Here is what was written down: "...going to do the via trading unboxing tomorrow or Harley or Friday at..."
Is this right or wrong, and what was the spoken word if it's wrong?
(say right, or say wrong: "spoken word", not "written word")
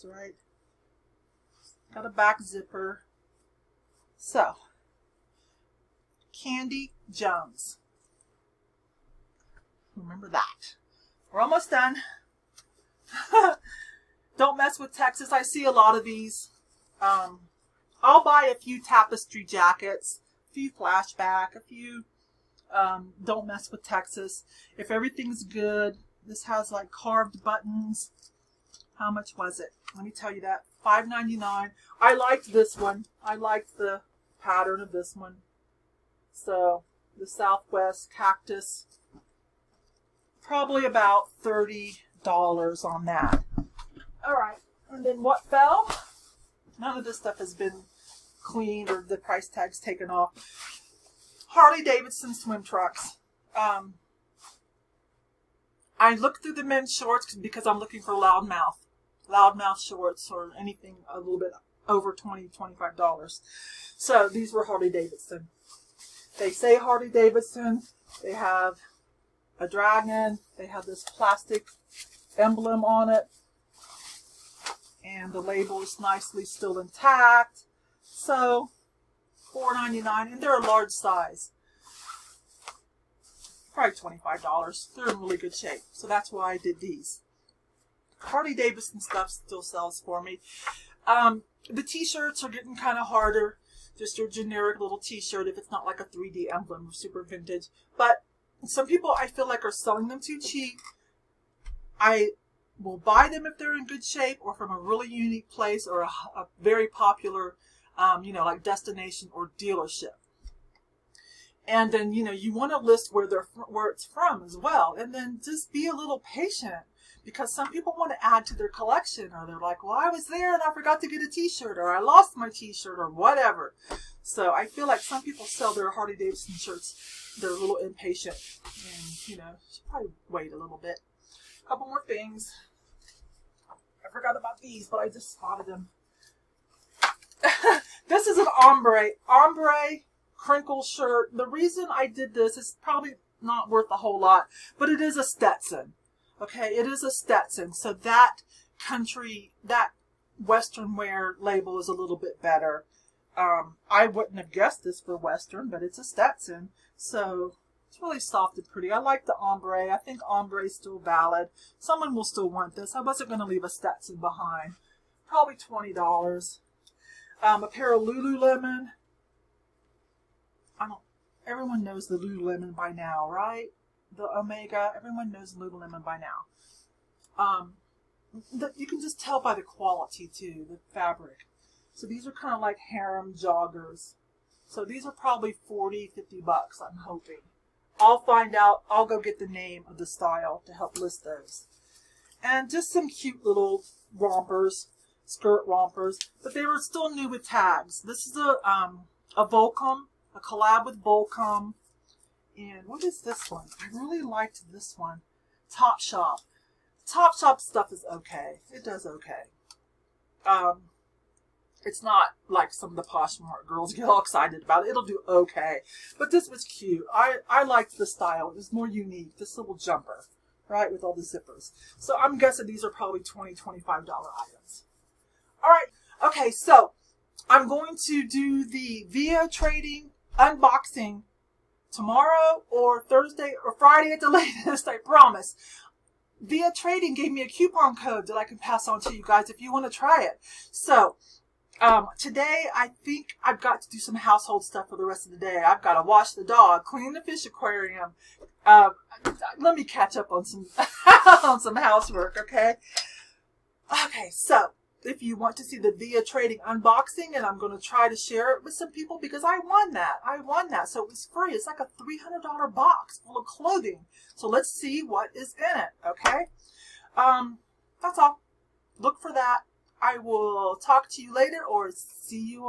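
wrong: "Thursday", not "Harley".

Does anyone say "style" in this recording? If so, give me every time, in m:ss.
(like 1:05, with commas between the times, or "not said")
3:10, 3:38.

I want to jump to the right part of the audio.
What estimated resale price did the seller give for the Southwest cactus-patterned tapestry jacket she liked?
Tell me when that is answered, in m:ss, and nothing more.
0:41.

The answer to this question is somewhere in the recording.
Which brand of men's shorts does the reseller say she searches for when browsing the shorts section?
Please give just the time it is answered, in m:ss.
0:59.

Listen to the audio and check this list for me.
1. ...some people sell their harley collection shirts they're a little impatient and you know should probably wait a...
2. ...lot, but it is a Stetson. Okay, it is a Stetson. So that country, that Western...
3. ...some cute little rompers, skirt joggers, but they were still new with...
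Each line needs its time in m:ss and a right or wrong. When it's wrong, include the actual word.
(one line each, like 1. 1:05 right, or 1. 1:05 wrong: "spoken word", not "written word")
1. 2:05 wrong: "davidson", not "collection"
2. 2:24 right
3. 3:12 wrong: "rompers", not "joggers".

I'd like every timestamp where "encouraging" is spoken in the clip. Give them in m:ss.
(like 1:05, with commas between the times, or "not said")
not said.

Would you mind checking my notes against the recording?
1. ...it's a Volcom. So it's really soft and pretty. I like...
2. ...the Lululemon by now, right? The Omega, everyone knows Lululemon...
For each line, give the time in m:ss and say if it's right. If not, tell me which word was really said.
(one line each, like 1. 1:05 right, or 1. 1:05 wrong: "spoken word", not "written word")
1. 2:35 wrong: "Stetson", not "Volcom"
2. 2:52 right.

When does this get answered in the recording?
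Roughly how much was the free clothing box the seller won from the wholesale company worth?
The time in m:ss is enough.
4:21.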